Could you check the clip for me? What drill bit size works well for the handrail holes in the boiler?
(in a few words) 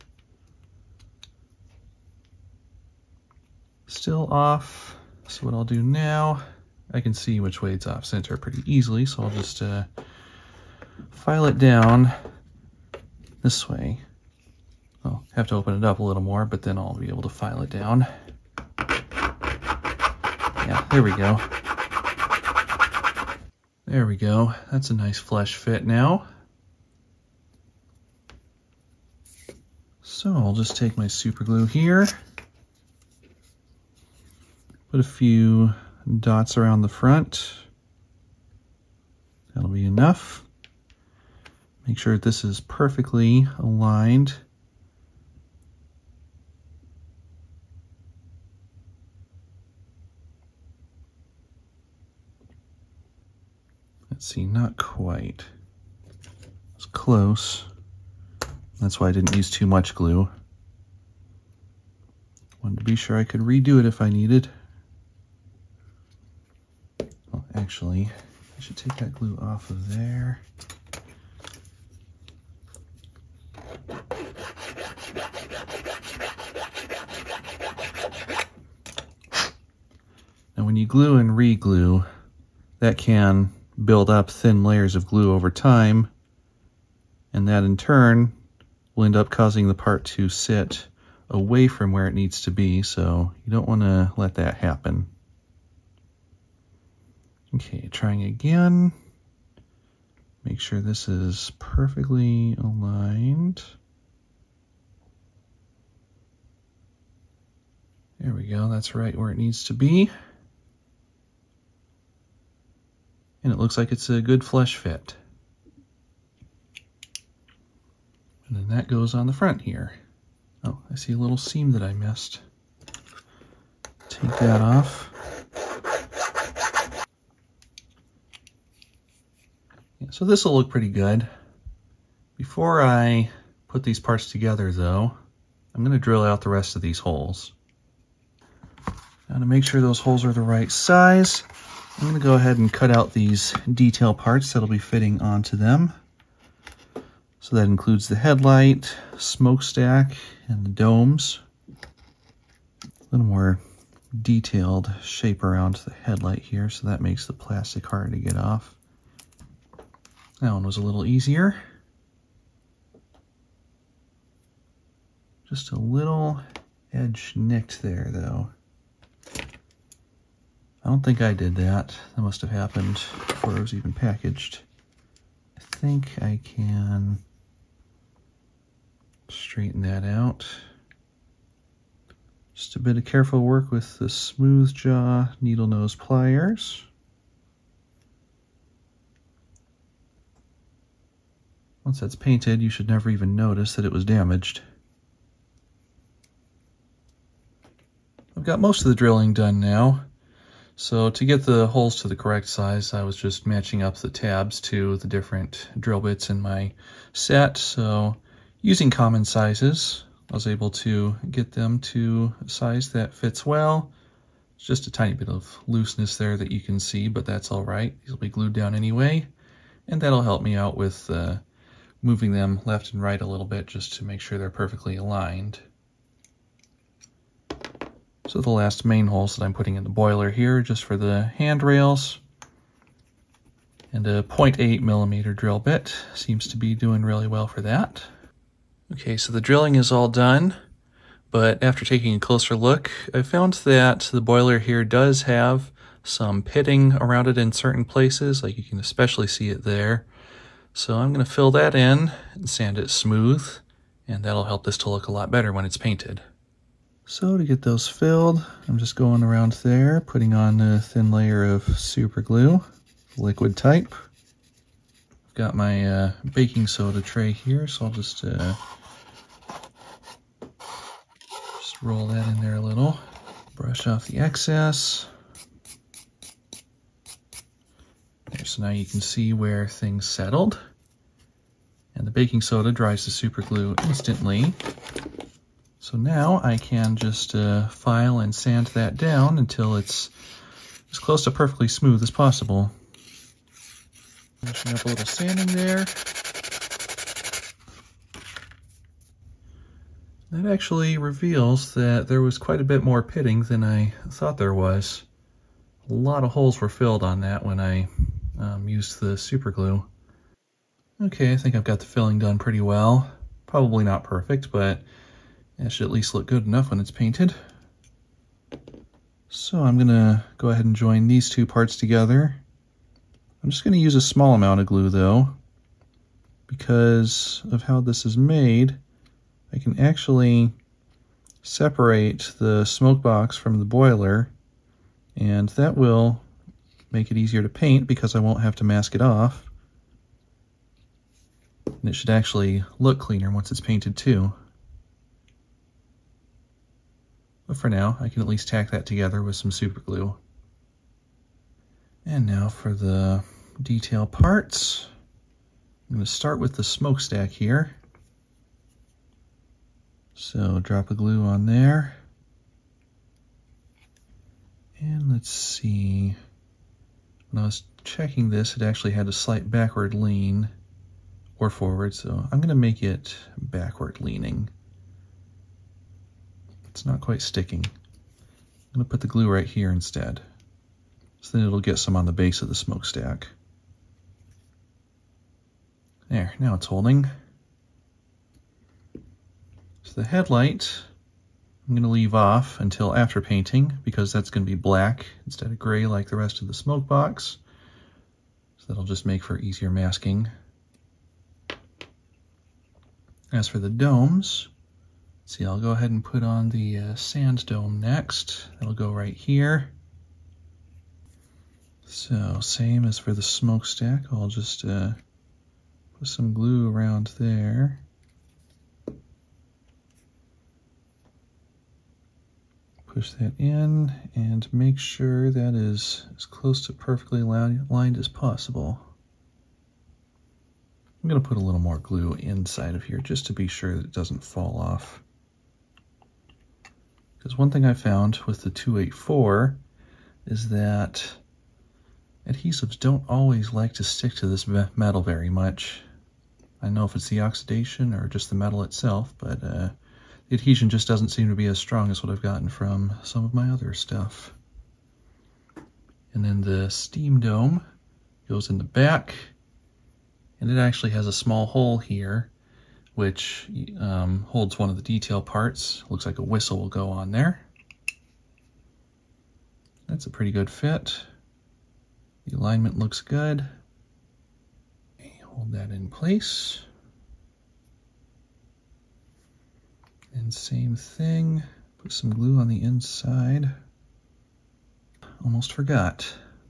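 0.8 millimeter.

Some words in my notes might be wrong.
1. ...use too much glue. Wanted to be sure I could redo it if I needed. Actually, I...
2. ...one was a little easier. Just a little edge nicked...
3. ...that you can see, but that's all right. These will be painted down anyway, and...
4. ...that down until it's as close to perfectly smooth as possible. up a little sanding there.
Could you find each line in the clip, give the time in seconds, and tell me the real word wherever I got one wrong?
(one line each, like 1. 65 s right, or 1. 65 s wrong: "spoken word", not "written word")
1. 59 s right
2. 160 s right
3. 216 s wrong: "glued", not "painted"
4. 288 s right.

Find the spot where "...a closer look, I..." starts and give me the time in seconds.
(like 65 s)
242 s.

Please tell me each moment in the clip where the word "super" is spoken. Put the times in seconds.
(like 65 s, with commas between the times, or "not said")
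31 s, 261 s, 283 s, 309 s, 349 s.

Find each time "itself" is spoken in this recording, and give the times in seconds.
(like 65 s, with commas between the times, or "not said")
448 s.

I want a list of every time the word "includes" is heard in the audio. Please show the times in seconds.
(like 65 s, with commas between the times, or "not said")
147 s.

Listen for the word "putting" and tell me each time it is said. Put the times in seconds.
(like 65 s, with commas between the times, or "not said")
229 s, 260 s.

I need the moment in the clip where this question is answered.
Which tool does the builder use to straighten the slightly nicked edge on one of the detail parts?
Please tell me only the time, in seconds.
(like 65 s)
184 s.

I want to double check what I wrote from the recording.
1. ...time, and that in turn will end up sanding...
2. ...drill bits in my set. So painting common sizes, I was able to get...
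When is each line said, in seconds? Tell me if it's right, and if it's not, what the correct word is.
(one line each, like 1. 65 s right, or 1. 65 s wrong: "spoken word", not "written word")
1. 85 s wrong: "causing", not "sanding"
2. 205 s wrong: "using", not "painting".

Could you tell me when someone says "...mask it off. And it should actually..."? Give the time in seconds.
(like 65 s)
338 s.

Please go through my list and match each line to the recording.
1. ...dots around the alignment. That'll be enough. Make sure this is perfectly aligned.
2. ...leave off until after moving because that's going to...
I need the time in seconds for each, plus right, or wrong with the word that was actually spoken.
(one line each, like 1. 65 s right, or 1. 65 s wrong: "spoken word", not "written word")
1. 36 s wrong: "front", not "alignment"
2. 391 s wrong: "painting", not "moving".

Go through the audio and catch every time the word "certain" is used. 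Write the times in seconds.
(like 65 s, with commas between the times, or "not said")
247 s.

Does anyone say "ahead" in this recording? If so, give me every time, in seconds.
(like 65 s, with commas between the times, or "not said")
142 s, 320 s, 405 s.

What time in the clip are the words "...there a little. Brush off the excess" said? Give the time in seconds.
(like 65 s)
272 s.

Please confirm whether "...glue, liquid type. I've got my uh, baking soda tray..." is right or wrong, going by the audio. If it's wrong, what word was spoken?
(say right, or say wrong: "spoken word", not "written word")
right.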